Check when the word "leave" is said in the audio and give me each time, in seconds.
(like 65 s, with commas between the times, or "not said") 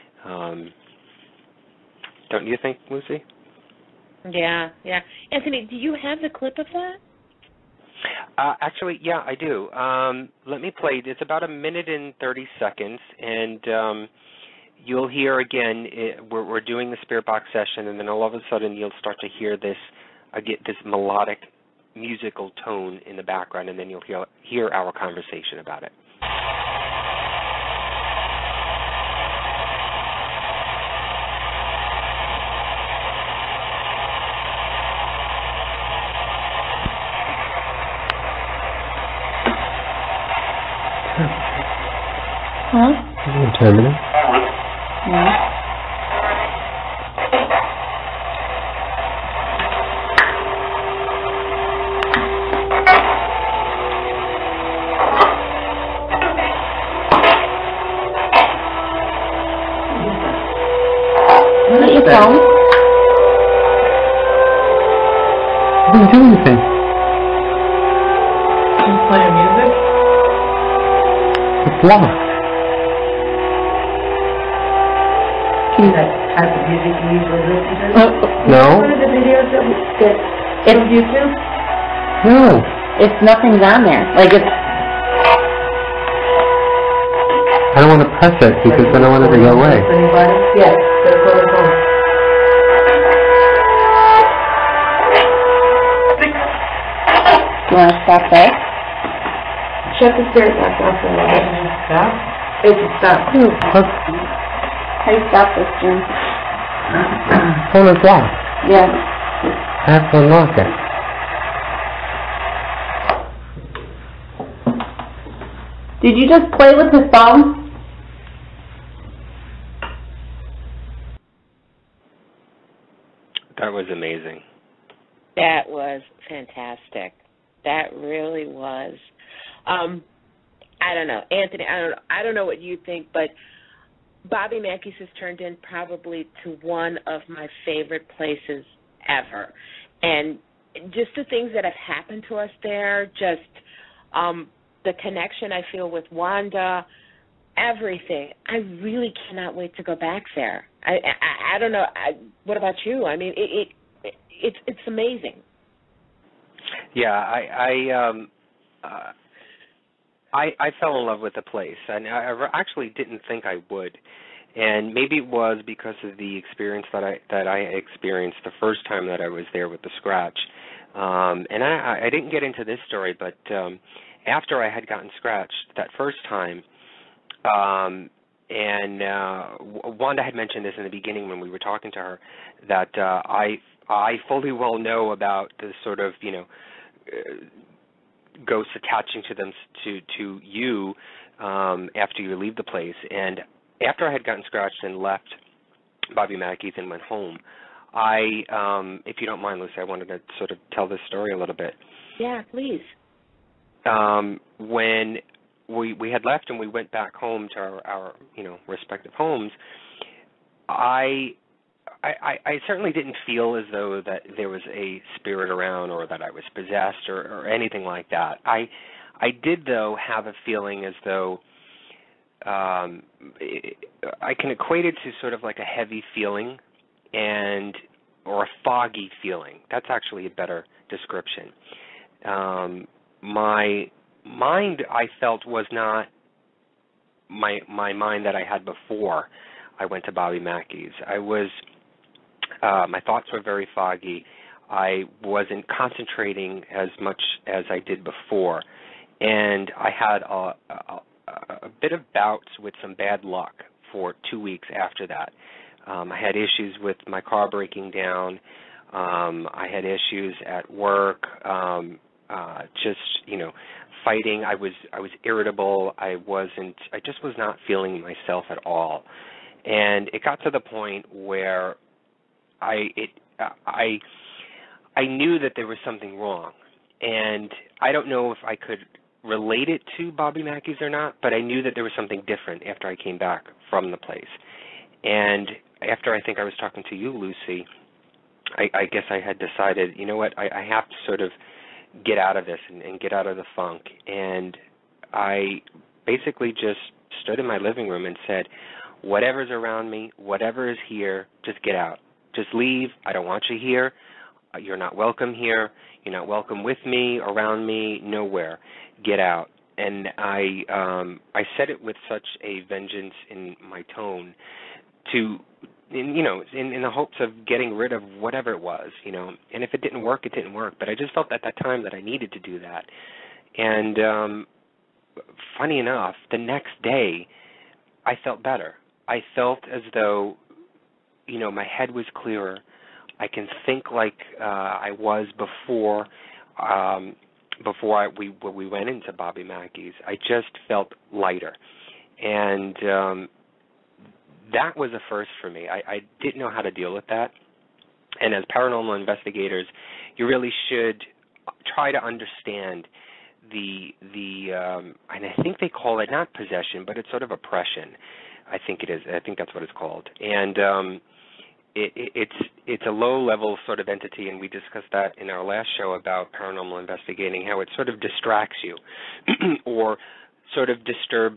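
192 s, 302 s.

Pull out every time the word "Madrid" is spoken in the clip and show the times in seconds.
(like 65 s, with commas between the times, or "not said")
not said.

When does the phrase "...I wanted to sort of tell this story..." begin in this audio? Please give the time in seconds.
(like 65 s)
199 s.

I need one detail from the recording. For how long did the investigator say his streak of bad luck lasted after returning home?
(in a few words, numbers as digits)
2 weeks.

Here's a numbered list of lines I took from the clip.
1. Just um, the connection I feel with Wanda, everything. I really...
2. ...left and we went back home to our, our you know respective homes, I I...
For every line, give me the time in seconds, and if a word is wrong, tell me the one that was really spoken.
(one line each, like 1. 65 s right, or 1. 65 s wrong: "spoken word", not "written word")
1. 143 s right
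2. 206 s right.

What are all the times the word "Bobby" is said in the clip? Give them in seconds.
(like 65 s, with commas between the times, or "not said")
134 s, 196 s, 240 s, 280 s, 339 s.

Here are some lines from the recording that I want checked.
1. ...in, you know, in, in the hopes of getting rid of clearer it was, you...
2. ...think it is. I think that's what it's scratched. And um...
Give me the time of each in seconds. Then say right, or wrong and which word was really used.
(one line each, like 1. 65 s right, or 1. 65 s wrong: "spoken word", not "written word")
1. 315 s wrong: "whatever", not "clearer"
2. 358 s wrong: "called", not "scratched".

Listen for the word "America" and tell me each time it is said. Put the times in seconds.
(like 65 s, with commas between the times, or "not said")
not said.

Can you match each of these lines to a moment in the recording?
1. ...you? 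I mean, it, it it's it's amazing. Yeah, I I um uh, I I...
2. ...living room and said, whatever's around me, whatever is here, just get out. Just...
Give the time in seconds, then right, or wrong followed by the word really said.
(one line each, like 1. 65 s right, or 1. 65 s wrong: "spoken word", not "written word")
1. 152 s right
2. 297 s right.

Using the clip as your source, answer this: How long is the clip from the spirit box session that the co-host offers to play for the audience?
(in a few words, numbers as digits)
1 minute 30 seconds.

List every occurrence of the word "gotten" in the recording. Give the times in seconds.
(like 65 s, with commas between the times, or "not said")
174 s, 194 s.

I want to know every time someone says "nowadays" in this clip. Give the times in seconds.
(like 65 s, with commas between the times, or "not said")
not said.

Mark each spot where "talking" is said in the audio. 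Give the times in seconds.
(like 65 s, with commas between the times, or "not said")
181 s, 286 s.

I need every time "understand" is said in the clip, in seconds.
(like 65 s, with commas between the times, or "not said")
352 s.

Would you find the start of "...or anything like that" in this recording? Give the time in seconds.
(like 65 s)
217 s.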